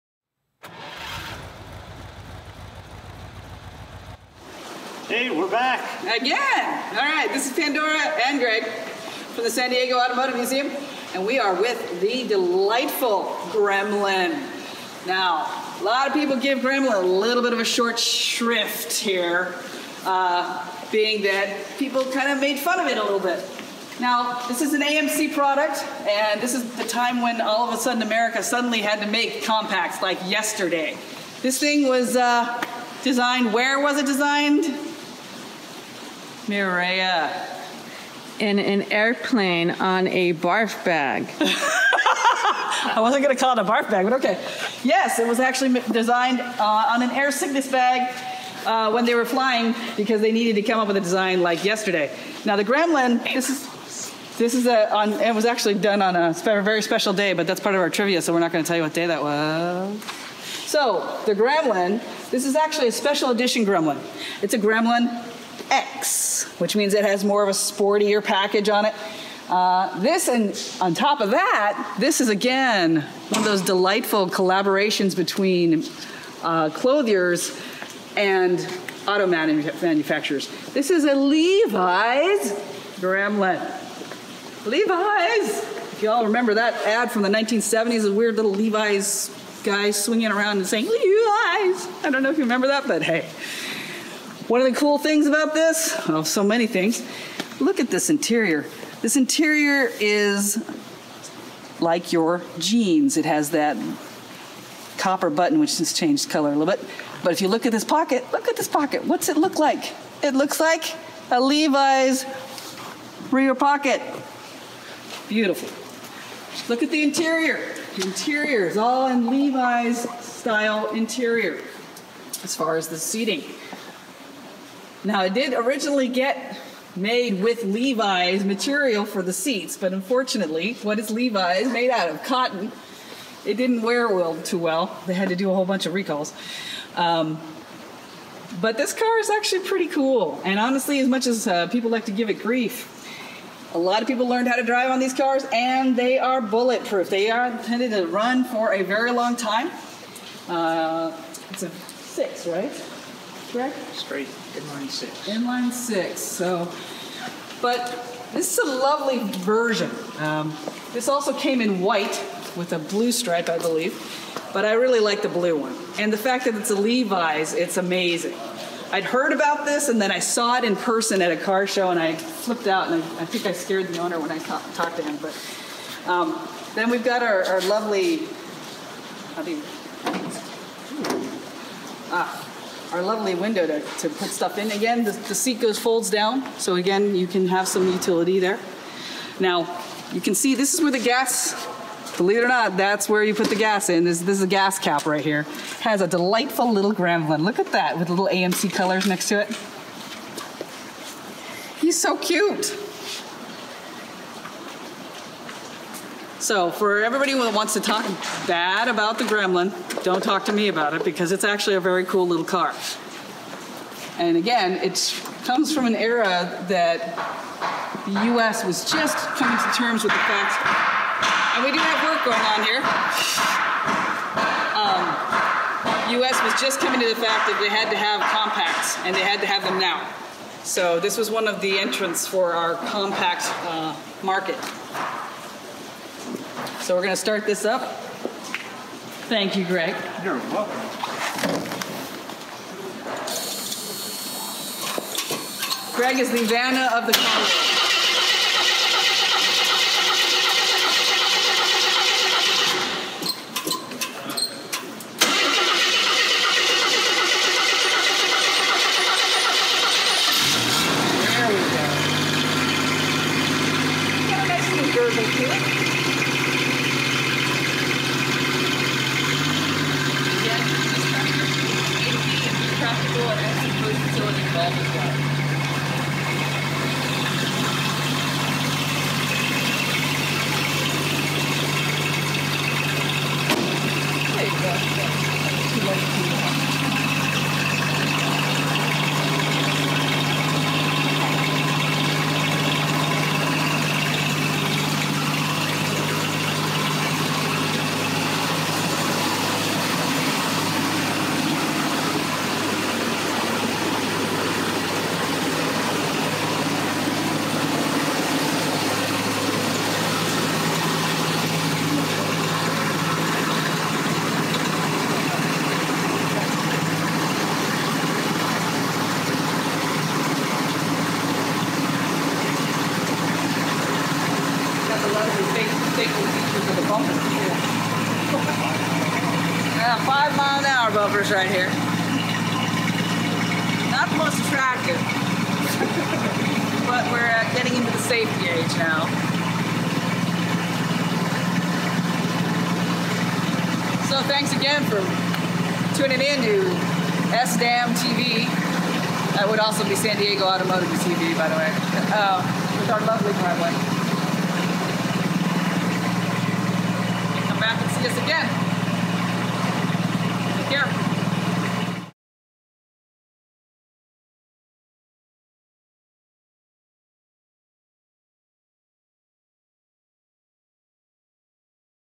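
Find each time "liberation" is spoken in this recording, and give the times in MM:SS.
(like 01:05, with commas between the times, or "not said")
not said.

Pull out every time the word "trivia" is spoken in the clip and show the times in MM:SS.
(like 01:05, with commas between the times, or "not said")
00:57.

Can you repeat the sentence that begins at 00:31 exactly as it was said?
This thing was uh, designed, where was it designed?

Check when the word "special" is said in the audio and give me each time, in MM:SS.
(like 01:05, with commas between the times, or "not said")
00:56, 01:02.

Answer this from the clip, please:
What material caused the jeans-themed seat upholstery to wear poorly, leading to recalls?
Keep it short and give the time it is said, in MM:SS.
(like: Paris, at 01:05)
Cotton, at 02:12.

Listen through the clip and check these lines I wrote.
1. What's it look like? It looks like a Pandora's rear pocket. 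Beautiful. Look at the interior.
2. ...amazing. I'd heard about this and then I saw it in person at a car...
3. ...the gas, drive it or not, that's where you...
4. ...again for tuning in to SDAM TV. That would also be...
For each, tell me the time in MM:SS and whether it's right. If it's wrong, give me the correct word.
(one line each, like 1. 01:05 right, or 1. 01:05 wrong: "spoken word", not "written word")
1. 01:49 wrong: "Levi", not "Pandora"
2. 02:47 right
3. 03:10 wrong: "believe", not "drive"
4. 05:44 right.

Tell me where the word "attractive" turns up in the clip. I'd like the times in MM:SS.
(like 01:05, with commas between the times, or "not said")
05:34.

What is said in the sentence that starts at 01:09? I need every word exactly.
Uh, this and on top of that, this is again one of those delightful collaborations between uh, clothiers and auto manufacturers.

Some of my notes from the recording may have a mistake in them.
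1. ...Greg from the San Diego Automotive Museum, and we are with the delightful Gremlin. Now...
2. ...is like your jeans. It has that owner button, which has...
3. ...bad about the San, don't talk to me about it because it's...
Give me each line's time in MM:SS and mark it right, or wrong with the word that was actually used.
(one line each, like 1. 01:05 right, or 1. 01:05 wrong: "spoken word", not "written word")
1. 00:08 right
2. 01:40 wrong: "copper", not "owner"
3. 03:28 wrong: "Gremlin", not "San".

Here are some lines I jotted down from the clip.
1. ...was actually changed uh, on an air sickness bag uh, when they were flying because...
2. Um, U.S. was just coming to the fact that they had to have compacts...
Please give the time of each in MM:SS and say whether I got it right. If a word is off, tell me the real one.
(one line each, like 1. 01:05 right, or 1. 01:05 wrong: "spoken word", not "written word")
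1. 00:45 wrong: "designed", not "changed"
2. 03:44 right.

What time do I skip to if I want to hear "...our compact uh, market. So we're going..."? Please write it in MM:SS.
03:52.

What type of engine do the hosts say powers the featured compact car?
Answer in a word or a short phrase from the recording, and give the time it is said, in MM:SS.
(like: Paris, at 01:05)
Straight inline six, at 02:33.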